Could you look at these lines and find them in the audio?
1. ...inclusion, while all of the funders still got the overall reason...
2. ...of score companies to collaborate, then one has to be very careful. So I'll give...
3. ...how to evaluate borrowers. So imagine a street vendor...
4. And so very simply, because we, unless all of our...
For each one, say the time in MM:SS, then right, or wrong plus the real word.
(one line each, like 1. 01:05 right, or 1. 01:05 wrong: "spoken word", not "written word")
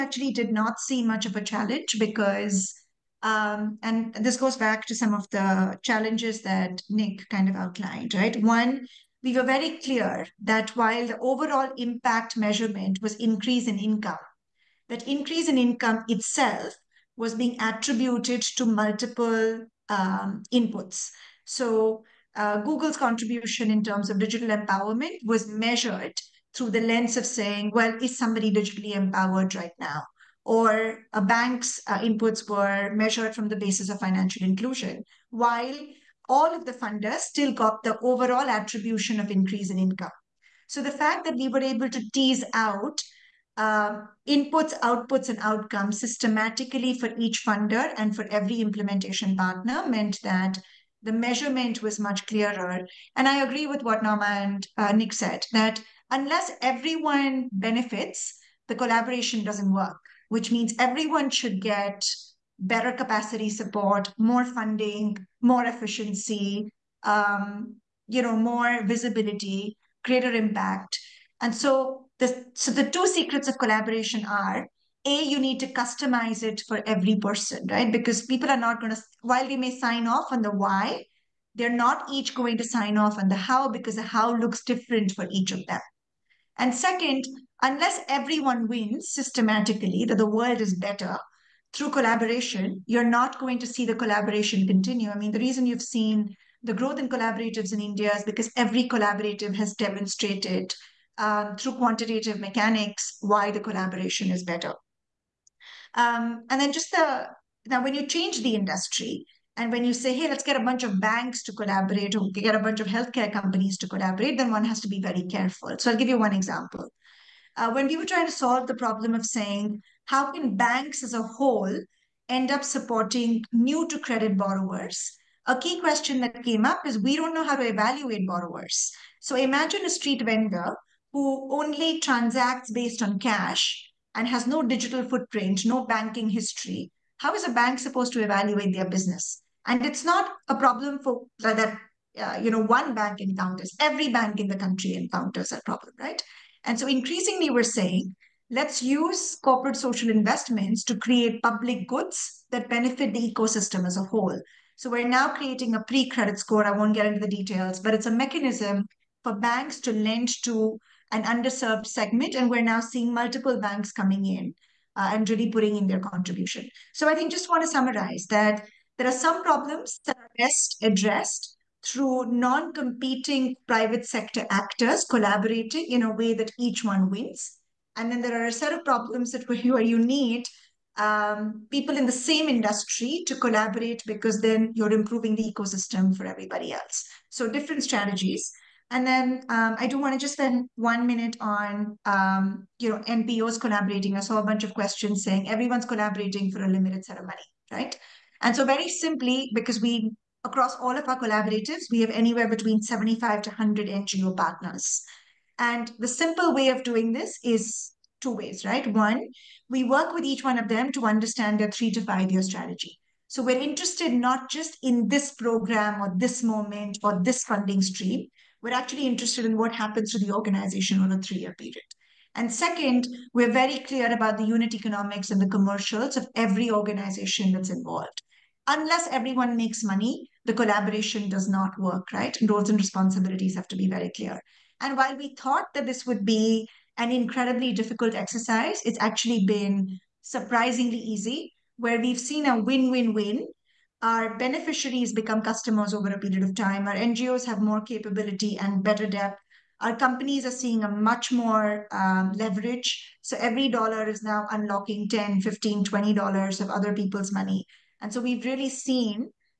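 1. 00:34 wrong: "attribution", not "reason"
2. 01:52 wrong: "healthcare", not "score"
3. 02:07 right
4. 03:18 wrong: "across", not "unless".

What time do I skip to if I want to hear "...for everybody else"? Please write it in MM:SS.
03:06.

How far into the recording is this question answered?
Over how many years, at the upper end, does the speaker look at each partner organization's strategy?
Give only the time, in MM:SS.
03:32.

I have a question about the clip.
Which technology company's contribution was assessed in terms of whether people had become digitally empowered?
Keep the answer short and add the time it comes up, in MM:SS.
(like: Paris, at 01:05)
Google, at 00:22.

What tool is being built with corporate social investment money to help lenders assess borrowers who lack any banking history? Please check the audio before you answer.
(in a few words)
Pre-credit score.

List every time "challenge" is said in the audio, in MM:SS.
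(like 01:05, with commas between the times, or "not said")
00:01, 00:05.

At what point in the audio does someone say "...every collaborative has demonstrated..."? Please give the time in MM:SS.
01:38.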